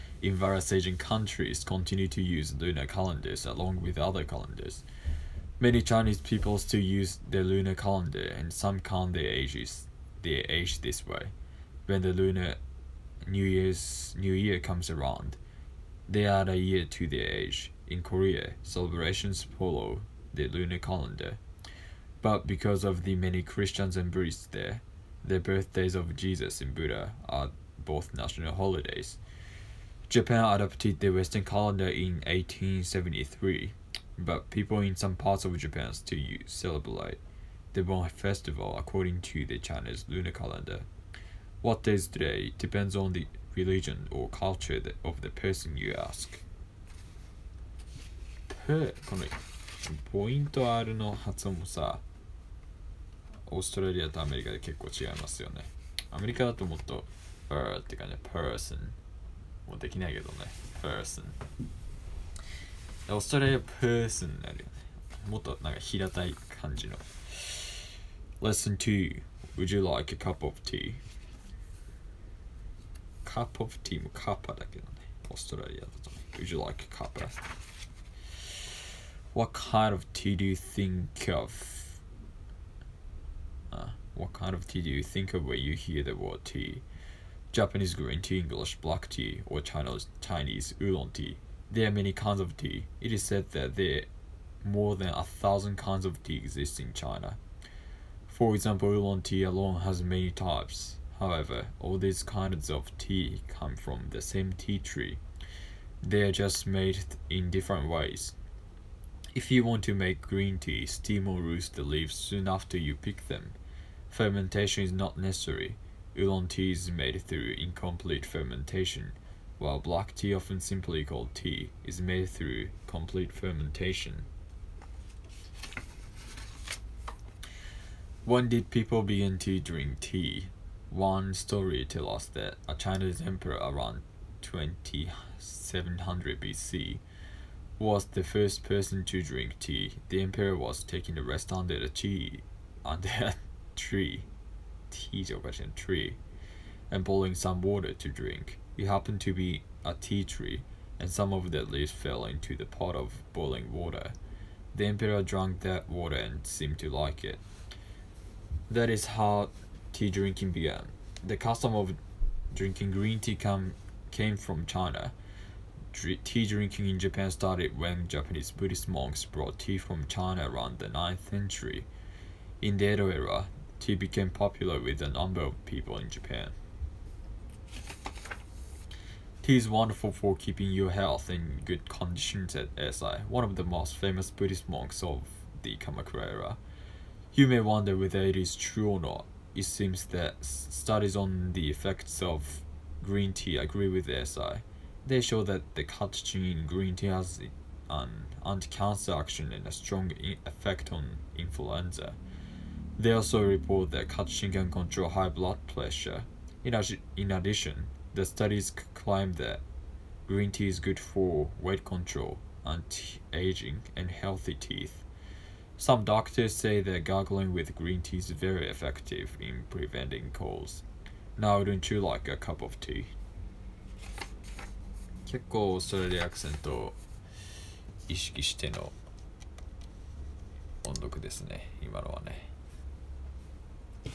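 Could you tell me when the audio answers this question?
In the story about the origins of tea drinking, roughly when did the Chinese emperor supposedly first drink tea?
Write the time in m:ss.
2:13.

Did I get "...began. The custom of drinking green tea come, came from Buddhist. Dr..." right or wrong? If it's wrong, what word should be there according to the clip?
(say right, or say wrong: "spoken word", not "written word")
wrong: "China", not "Buddhist".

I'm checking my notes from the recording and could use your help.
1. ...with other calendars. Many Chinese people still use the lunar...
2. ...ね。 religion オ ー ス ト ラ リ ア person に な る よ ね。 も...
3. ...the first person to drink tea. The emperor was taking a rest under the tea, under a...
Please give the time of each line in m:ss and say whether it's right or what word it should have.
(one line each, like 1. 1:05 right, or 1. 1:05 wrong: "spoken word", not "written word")
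1. 0:03 right
2. 1:00 wrong: "person", not "religion"
3. 2:18 right.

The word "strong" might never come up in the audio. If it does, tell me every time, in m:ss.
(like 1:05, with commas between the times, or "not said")
3:19.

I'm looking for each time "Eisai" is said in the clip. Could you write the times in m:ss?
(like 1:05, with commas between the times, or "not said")
3:02, 3:14.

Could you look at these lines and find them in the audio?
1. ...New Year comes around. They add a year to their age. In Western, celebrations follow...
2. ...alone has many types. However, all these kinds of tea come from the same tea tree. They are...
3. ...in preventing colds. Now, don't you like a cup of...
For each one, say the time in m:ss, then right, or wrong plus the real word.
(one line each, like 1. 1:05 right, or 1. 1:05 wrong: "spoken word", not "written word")
1. 0:14 wrong: "Korea", not "Western"
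2. 1:39 right
3. 3:39 right.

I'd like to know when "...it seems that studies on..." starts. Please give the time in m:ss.
3:09.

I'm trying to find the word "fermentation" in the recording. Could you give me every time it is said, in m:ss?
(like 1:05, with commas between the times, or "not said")
1:54, 1:58, 2:03.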